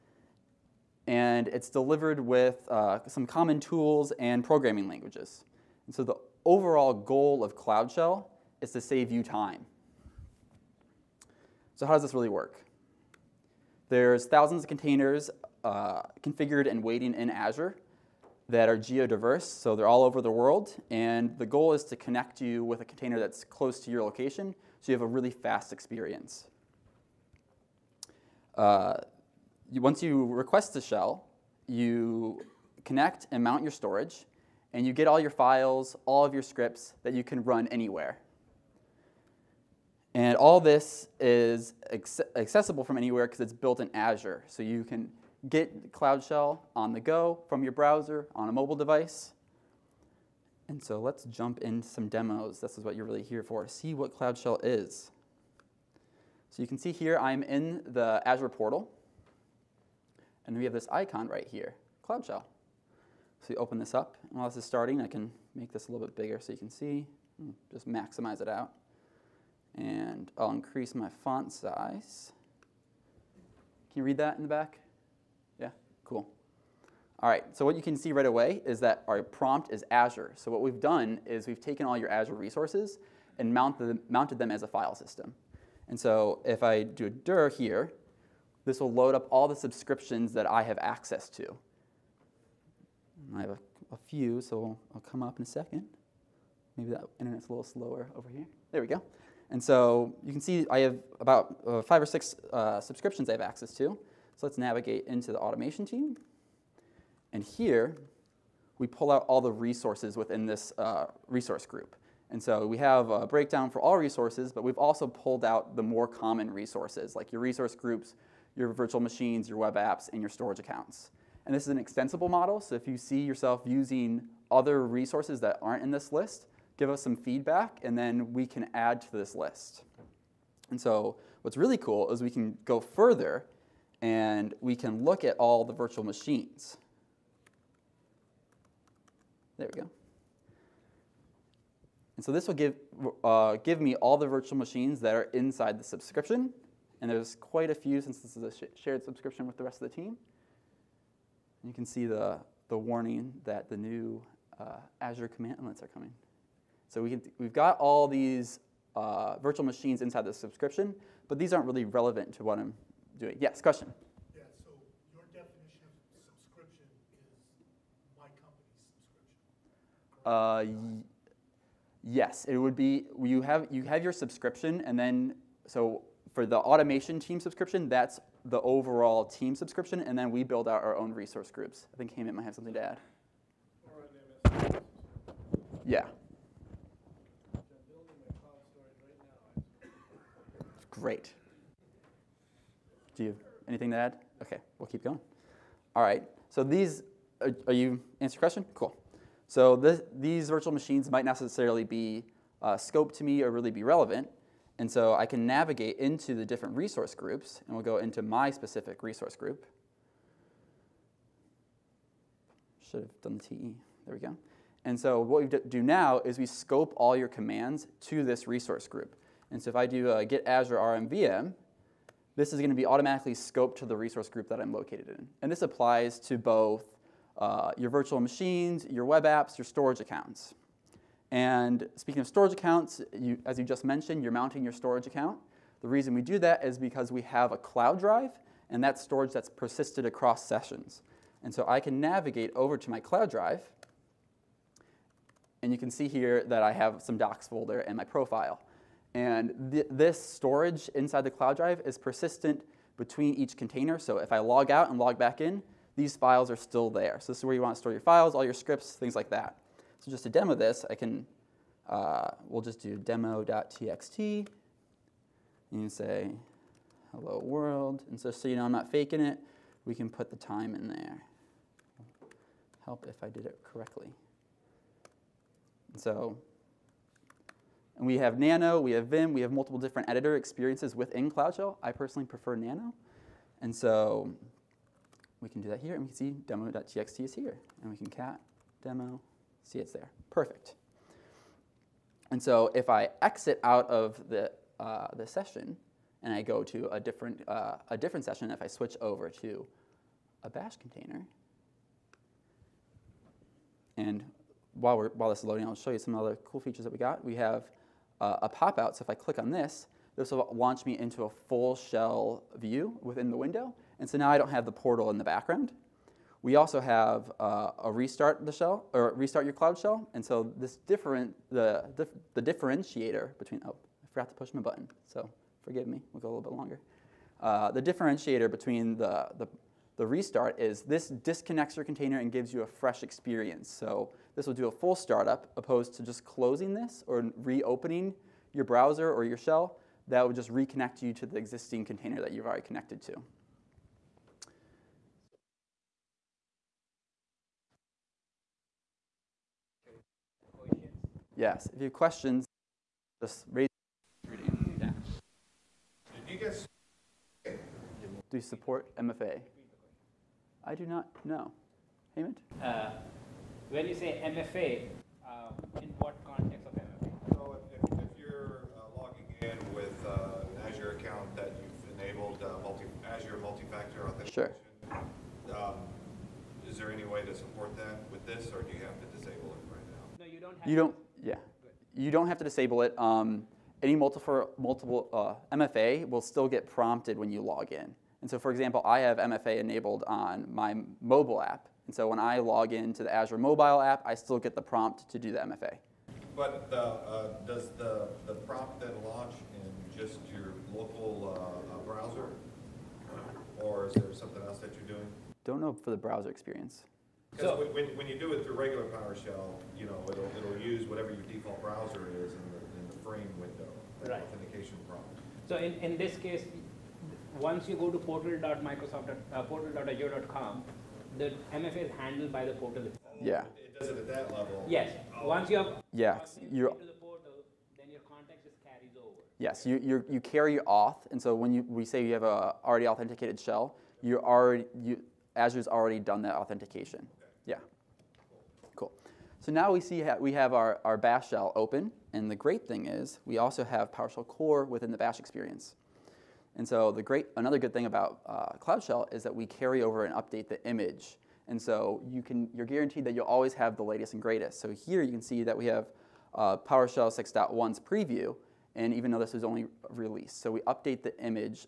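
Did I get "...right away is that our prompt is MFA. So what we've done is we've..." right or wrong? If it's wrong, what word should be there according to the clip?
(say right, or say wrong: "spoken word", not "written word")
wrong: "Azure", not "MFA".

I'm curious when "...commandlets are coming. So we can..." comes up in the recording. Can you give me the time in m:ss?
2:35.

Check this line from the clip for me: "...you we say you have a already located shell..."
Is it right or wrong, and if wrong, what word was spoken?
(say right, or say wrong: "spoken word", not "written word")
wrong: "authenticated", not "located".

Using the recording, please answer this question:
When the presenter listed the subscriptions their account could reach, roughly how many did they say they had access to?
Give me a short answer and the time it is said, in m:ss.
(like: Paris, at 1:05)
5 or 6, at 1:41.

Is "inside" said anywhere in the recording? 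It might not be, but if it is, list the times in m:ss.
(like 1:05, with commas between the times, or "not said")
2:25, 2:40, 4:10.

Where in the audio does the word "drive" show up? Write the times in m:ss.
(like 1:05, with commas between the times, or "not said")
3:57, 4:03, 4:11.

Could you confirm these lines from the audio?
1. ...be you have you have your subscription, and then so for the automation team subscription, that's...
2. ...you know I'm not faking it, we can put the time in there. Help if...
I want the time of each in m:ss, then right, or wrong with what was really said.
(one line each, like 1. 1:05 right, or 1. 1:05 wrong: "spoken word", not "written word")
1. 2:52 right
2. 4:28 right.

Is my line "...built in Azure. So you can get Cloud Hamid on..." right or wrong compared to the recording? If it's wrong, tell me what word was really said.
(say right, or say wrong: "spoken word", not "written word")
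wrong: "Shell", not "Hamid".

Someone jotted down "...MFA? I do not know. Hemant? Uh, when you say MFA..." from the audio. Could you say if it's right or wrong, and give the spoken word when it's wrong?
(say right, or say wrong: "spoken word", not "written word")
right.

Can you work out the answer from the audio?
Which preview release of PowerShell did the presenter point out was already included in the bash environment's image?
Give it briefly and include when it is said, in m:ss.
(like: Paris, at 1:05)
PowerShell 6.1, at 7:36.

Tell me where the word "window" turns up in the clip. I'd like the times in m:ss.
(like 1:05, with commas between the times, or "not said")
5:13, 6:53.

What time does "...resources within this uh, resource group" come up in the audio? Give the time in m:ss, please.
1:49.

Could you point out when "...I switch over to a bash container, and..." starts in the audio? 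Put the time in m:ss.
4:58.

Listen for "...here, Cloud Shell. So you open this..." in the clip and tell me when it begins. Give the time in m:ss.
1:01.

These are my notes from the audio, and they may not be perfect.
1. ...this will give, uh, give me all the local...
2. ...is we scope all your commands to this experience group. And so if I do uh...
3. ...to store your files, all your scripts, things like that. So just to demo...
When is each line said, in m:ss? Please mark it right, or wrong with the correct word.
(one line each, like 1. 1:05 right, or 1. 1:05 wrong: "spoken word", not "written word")
1. 2:22 wrong: "virtual", not "local"
2. 3:36 wrong: "resource", not "experience"
3. 4:17 right.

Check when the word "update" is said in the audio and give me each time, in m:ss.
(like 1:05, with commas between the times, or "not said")
7:30, 7:40.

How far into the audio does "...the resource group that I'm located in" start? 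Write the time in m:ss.
3:43.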